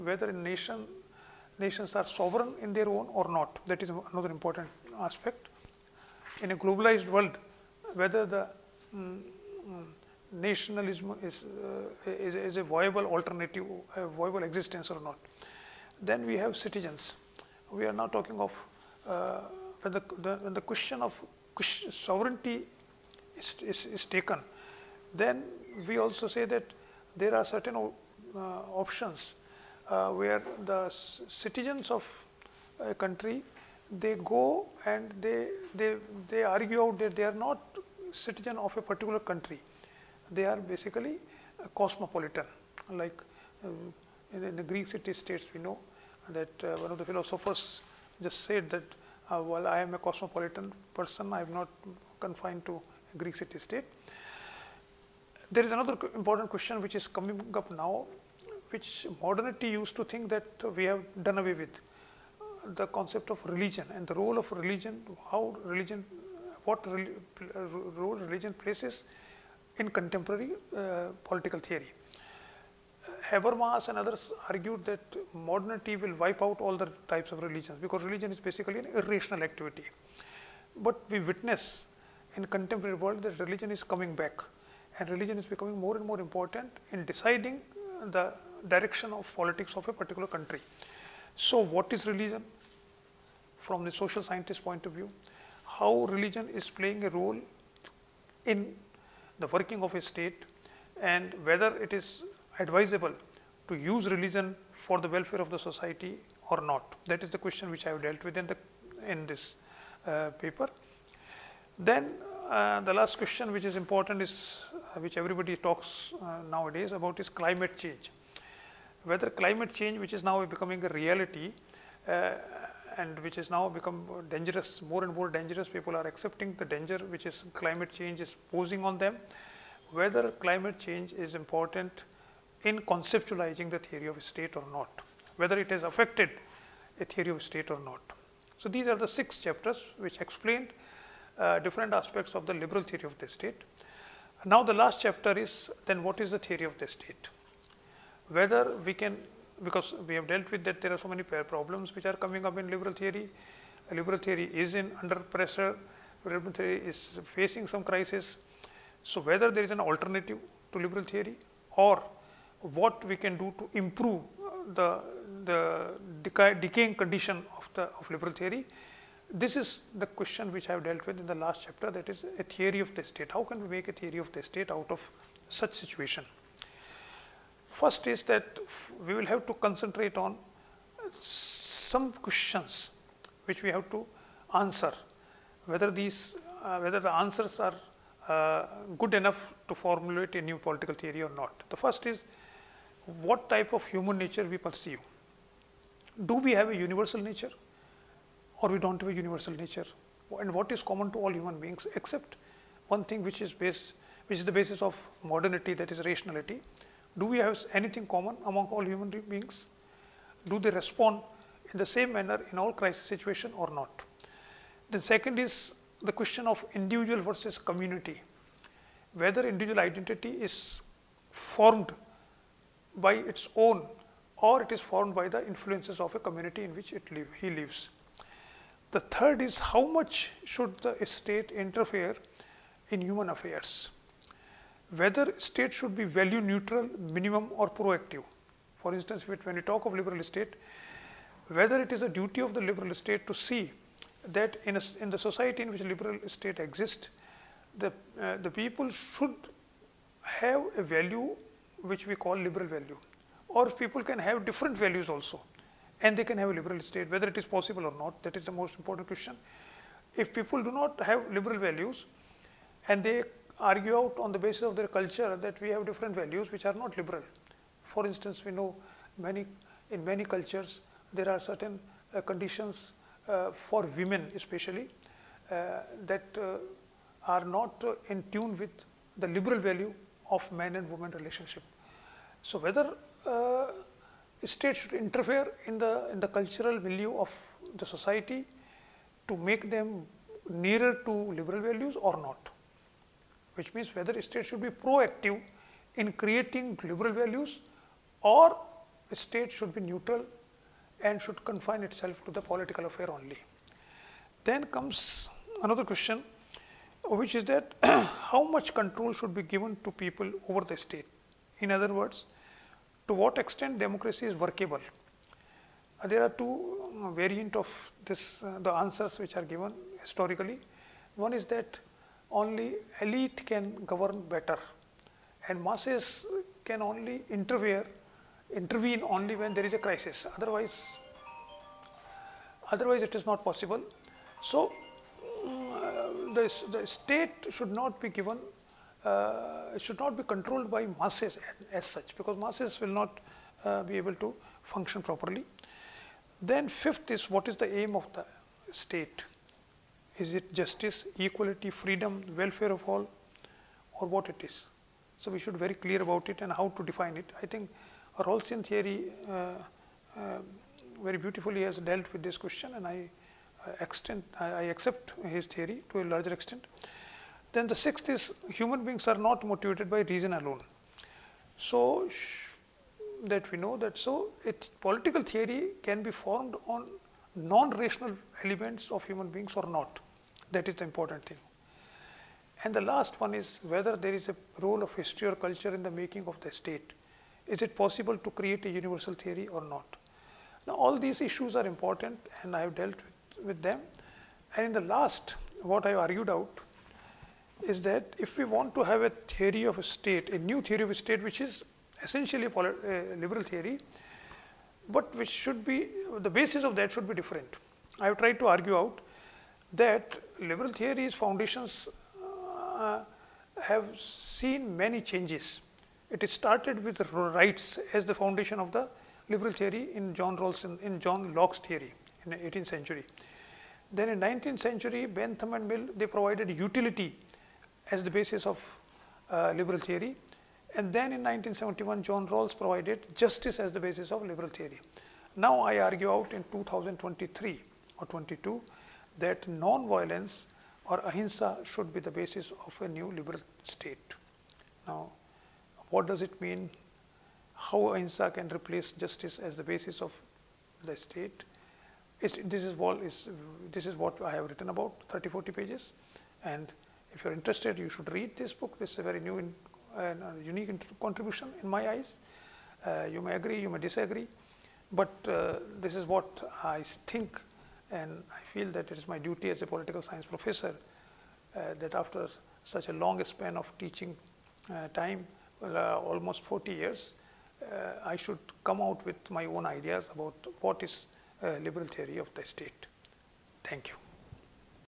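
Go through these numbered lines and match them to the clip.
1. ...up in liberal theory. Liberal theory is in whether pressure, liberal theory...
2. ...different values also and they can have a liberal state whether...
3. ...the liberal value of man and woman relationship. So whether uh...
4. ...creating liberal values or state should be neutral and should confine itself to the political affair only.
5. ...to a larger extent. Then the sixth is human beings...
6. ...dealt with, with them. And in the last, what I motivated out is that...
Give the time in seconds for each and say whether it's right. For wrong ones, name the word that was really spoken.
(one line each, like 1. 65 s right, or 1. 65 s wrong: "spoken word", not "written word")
1. 152 s wrong: "under", not "whether"
2. 254 s right
3. 279 s right
4. 296 s right
5. 365 s right
6. 392 s wrong: "argued", not "motivated".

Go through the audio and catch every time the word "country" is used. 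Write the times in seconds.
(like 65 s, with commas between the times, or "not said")
32 s, 39 s, 90 s.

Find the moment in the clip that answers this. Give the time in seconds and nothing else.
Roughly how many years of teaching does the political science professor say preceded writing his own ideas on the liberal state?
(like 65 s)
475 s.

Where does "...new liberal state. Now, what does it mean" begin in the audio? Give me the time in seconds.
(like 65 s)
442 s.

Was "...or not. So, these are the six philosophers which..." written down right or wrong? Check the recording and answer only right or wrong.
wrong.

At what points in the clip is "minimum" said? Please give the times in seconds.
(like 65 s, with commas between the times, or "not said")
236 s.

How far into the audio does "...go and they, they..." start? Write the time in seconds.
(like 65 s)
34 s.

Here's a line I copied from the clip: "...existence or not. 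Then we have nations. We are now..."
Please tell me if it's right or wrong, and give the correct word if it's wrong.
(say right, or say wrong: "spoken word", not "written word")
wrong: "citizens", not "nations".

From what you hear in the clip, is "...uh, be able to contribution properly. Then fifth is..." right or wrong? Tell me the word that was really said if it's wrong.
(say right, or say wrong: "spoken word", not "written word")
wrong: "function", not "contribution".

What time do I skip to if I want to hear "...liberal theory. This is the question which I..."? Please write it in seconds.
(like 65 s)
168 s.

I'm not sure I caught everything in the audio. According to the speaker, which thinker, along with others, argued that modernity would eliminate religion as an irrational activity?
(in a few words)
Habermas.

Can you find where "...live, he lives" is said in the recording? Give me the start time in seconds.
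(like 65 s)
227 s.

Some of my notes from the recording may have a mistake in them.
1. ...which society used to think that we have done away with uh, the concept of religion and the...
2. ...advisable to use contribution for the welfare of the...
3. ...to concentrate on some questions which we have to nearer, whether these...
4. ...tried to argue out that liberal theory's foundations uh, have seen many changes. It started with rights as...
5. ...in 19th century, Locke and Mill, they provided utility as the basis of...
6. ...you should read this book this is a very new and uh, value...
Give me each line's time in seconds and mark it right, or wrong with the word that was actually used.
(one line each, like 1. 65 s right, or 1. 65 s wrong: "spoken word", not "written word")
1. 58 s wrong: "modernity", not "society"
2. 102 s wrong: "religion", not "contribution"
3. 179 s wrong: "answer", not "nearer"
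4. 408 s right
5. 424 s wrong: "Bentham", not "Locke"
6. 457 s wrong: "unique", not "value".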